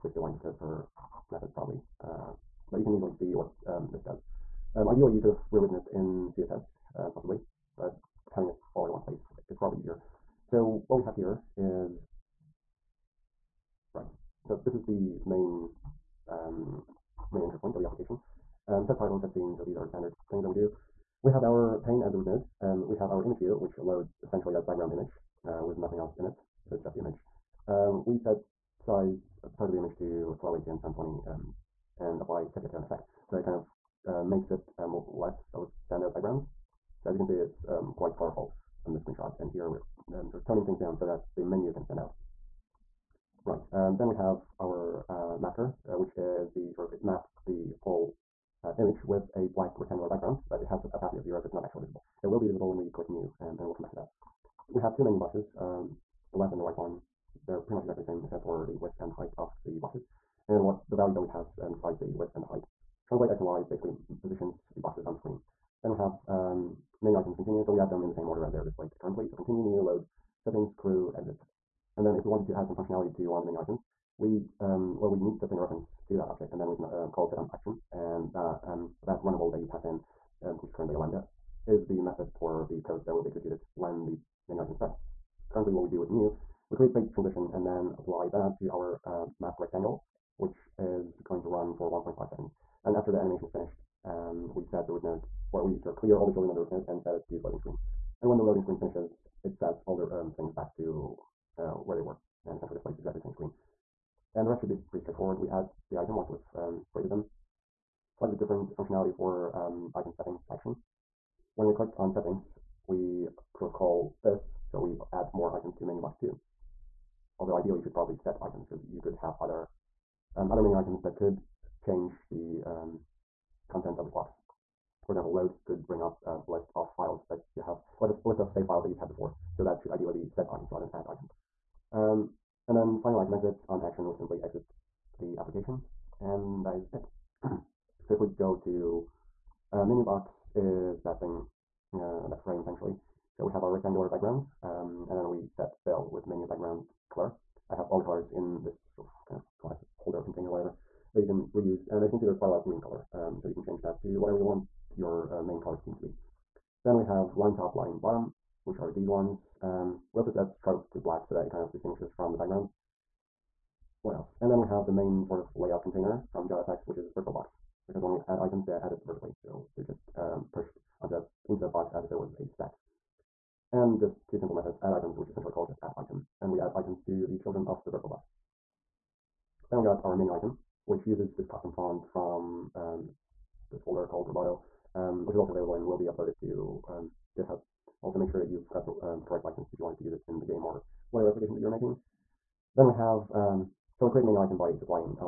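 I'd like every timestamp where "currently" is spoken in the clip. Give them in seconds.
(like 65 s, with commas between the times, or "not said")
68 s, 80 s, 85 s.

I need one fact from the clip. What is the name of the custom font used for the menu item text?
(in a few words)
Roboto.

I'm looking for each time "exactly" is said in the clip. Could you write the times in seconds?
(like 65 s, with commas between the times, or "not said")
57 s, 102 s.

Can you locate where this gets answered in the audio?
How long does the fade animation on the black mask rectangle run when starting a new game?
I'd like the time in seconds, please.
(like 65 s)
91 s.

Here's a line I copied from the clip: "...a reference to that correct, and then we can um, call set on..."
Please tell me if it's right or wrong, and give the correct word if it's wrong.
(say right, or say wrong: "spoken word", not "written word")
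wrong: "object", not "correct".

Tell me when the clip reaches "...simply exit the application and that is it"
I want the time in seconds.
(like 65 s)
134 s.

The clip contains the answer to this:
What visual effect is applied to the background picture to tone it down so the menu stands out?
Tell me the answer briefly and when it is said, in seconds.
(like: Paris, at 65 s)
Sepia tone, at 32 s.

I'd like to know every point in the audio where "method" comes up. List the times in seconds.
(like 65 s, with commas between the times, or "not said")
1 s, 82 s, 174 s.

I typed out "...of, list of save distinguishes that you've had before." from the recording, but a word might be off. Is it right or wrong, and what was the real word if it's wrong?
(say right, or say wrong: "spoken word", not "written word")
wrong: "files", not "distinguishes".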